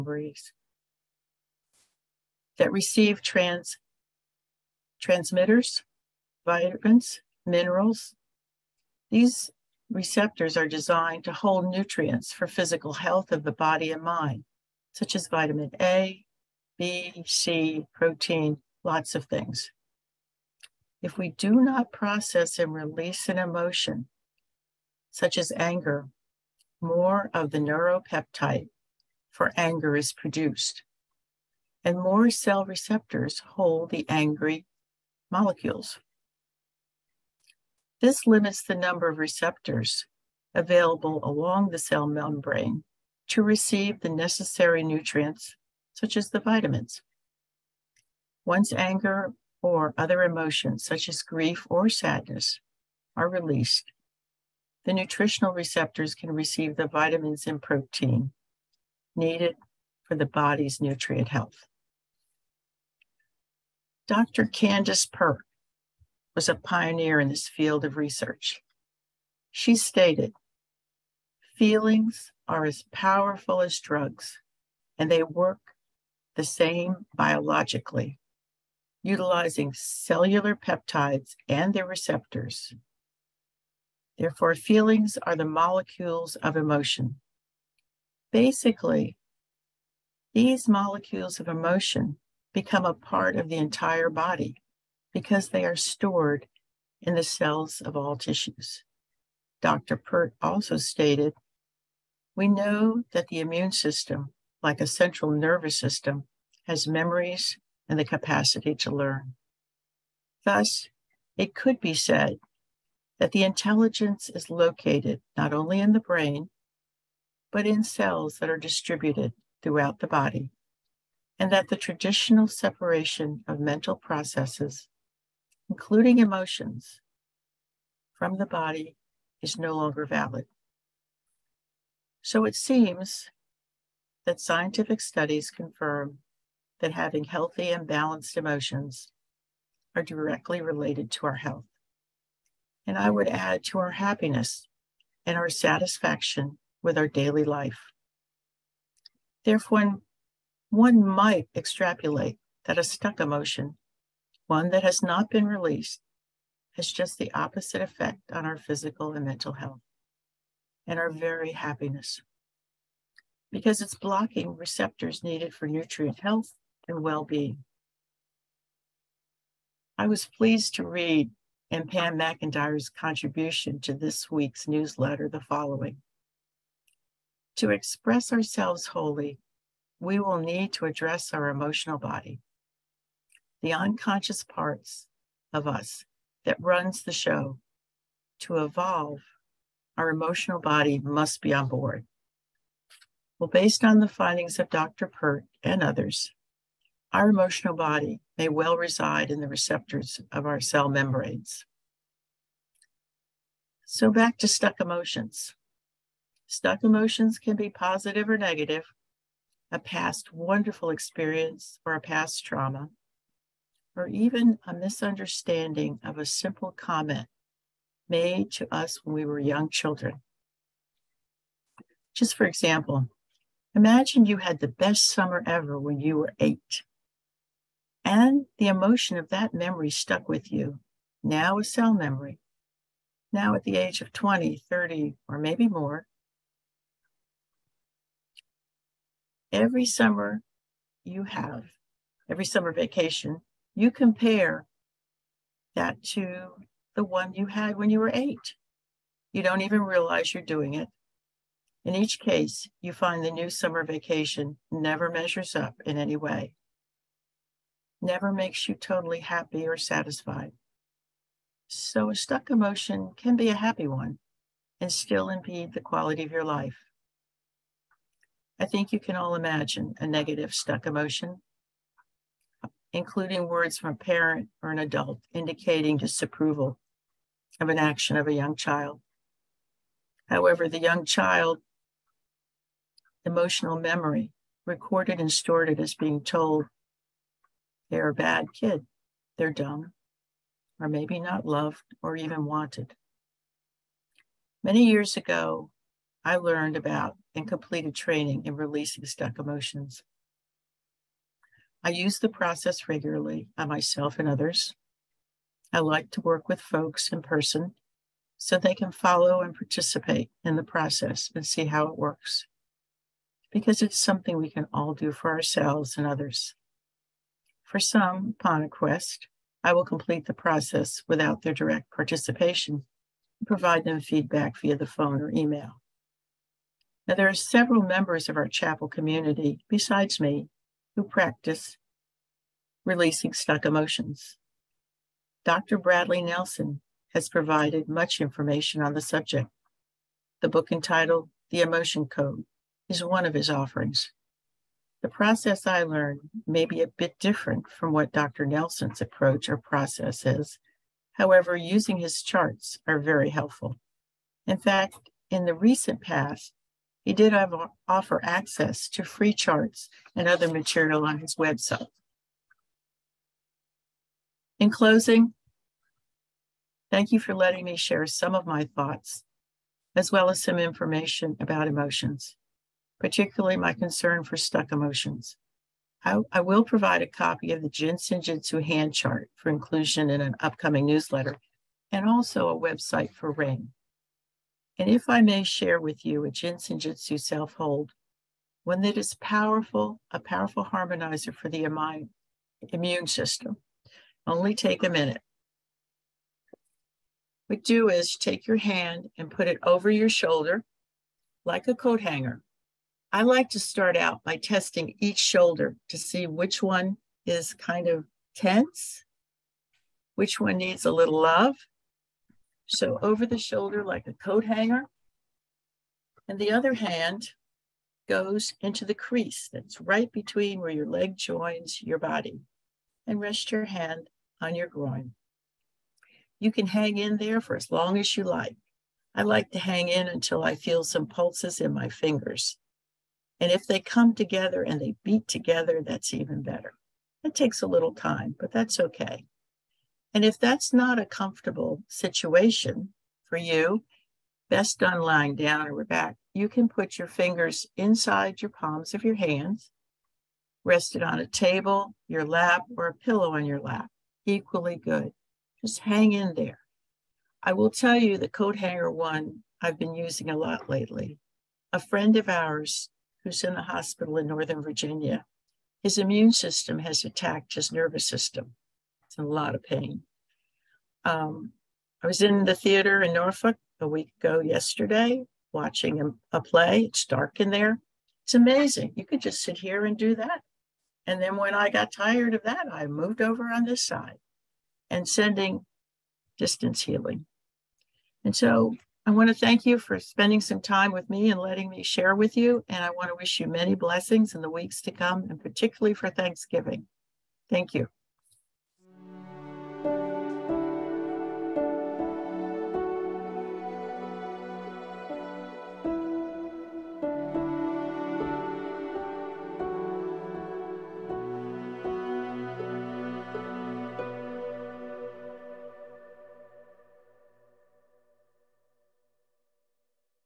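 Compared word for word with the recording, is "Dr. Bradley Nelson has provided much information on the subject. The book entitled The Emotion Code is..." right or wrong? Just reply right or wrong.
right.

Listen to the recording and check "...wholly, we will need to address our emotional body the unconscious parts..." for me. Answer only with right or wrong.
right.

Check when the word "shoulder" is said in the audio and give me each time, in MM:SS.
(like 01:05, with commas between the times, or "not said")
06:40, 06:45, 06:53.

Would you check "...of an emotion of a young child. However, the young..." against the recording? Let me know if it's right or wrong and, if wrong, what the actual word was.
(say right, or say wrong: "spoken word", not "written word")
wrong: "action", not "emotion".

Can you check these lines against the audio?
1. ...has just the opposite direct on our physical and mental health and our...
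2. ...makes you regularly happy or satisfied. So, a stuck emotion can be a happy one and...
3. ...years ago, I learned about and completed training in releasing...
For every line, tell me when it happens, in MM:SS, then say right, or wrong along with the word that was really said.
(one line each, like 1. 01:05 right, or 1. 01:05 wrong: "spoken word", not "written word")
1. 02:36 wrong: "effect", not "direct"
2. 04:18 wrong: "totally", not "regularly"
3. 04:54 right.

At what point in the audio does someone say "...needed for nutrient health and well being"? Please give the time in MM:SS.
02:45.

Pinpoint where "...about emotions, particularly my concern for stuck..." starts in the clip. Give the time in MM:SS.
06:11.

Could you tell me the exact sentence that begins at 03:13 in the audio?
Well, based on the findings of Dr.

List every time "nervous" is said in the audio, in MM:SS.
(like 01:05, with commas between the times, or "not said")
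01:45, 07:47.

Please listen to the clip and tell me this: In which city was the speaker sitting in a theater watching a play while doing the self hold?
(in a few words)
Norfolk.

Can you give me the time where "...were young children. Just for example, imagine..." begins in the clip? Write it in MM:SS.
03:39.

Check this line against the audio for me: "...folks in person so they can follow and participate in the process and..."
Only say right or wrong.
right.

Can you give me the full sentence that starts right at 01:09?
She stated, feelings are as powerful as drugs, and they work the same biologically, utilizing cellular peptides and their receptors.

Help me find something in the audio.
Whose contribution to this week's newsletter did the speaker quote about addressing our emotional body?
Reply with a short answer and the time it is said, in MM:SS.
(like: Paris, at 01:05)
Pam McIntyre, at 02:51.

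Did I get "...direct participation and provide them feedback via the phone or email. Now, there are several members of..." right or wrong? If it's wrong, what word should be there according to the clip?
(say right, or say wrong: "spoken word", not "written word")
right.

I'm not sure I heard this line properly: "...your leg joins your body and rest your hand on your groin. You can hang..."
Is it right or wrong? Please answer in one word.
right.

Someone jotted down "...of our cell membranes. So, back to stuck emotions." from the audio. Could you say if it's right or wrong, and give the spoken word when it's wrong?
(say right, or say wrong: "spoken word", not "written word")
right.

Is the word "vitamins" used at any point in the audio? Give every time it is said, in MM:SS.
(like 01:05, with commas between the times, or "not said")
00:06, 00:15, 00:46, 00:56.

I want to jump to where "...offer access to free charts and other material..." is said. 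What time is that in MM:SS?
05:57.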